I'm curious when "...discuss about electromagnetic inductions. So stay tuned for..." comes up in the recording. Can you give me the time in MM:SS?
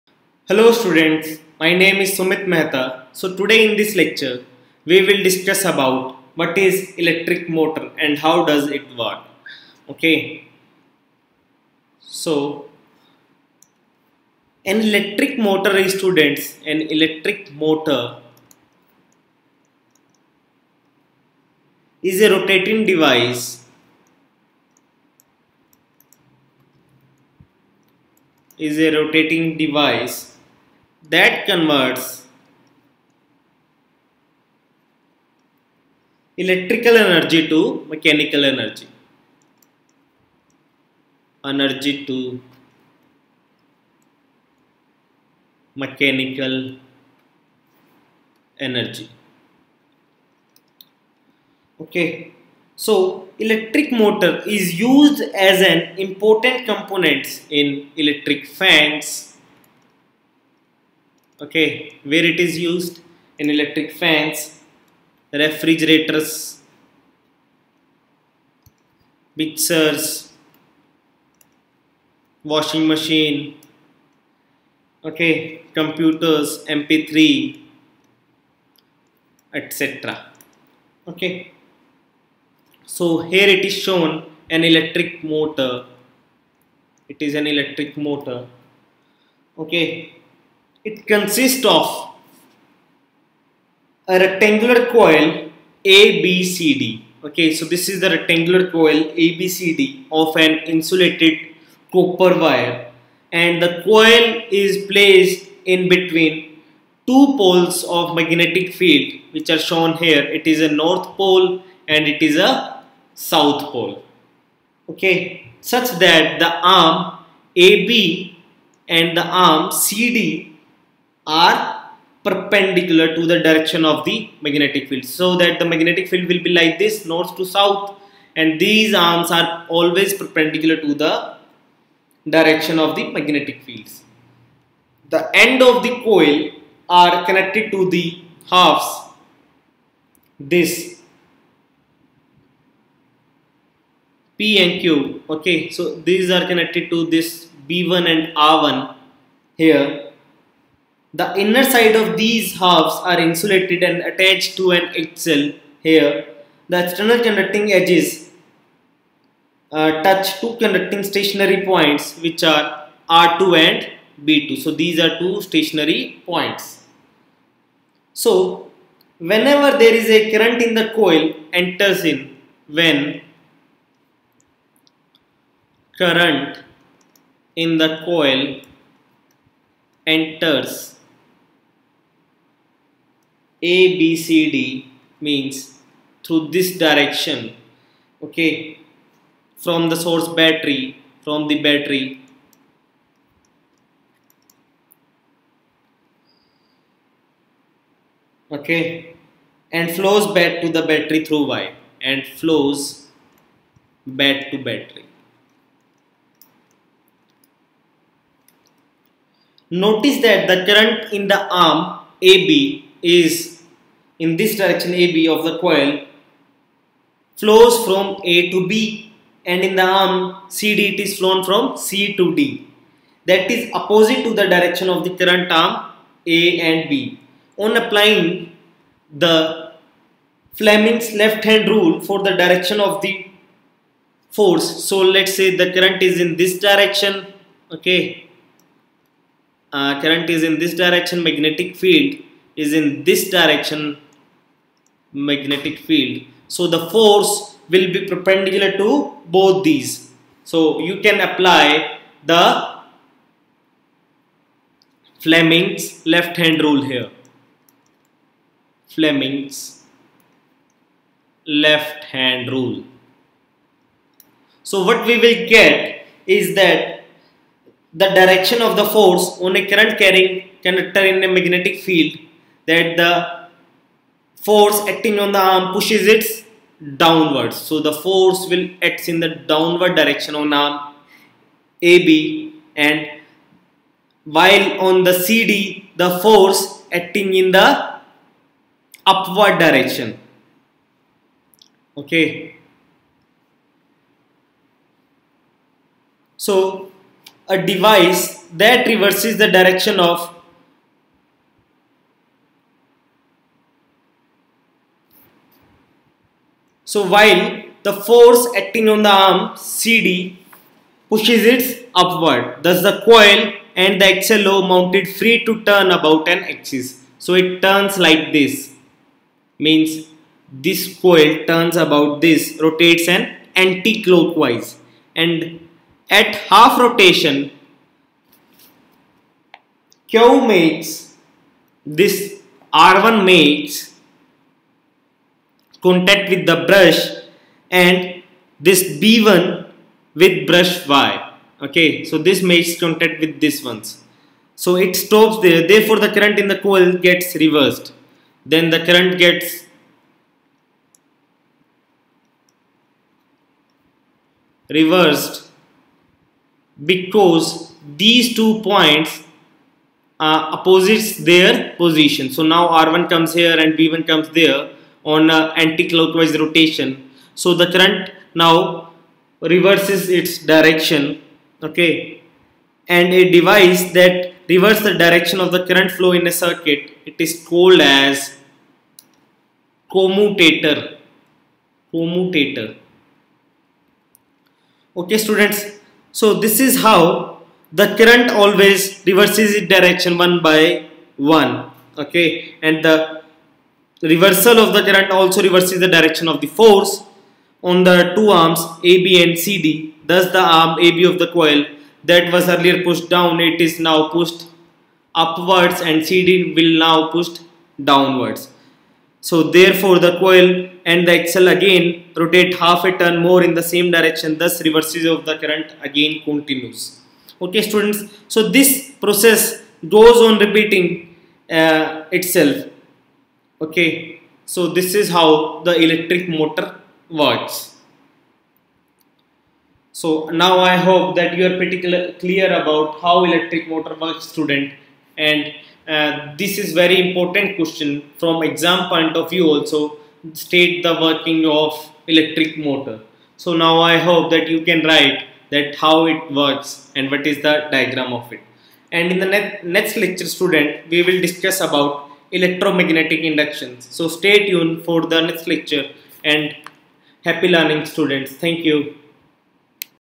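07:31.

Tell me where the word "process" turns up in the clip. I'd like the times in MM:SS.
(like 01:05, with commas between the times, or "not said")
06:58.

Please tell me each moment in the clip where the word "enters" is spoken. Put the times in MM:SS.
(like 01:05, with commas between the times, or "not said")
02:51, 03:00.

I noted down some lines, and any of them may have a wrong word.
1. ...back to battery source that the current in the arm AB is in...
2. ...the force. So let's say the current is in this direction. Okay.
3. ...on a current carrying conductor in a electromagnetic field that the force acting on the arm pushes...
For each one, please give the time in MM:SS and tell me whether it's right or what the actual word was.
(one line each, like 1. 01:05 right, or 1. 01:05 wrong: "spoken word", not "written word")
1. 03:24 wrong: "notice", not "source"
2. 03:53 right
3. 04:29 wrong: "magnetic", not "electromagnetic".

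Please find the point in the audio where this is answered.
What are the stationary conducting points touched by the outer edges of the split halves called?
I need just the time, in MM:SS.
02:43.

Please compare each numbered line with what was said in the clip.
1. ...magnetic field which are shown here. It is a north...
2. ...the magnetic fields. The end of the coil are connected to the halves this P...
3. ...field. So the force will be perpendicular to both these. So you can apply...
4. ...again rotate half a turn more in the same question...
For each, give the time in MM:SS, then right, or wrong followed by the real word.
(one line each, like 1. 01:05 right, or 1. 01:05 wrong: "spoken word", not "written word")
1. 01:48 right
2. 02:12 right
3. 04:05 right
4. 06:51 wrong: "direction", not "question".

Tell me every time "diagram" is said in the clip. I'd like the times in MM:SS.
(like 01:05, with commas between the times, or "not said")
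07:27.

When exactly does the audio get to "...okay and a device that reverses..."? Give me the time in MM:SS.
06:11.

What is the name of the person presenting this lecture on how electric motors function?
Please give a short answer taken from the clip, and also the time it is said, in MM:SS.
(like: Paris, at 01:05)
Sumit Mehta, at 00:02.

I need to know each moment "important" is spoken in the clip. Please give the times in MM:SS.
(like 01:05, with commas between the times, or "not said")
00:55, 07:17.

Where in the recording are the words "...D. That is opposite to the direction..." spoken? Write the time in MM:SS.
03:42.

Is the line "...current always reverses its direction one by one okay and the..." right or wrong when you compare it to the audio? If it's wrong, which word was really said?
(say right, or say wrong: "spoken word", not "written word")
right.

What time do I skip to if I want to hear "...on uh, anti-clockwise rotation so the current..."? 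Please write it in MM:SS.
06:05.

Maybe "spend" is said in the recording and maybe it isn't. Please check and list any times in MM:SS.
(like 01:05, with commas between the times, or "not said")
not said.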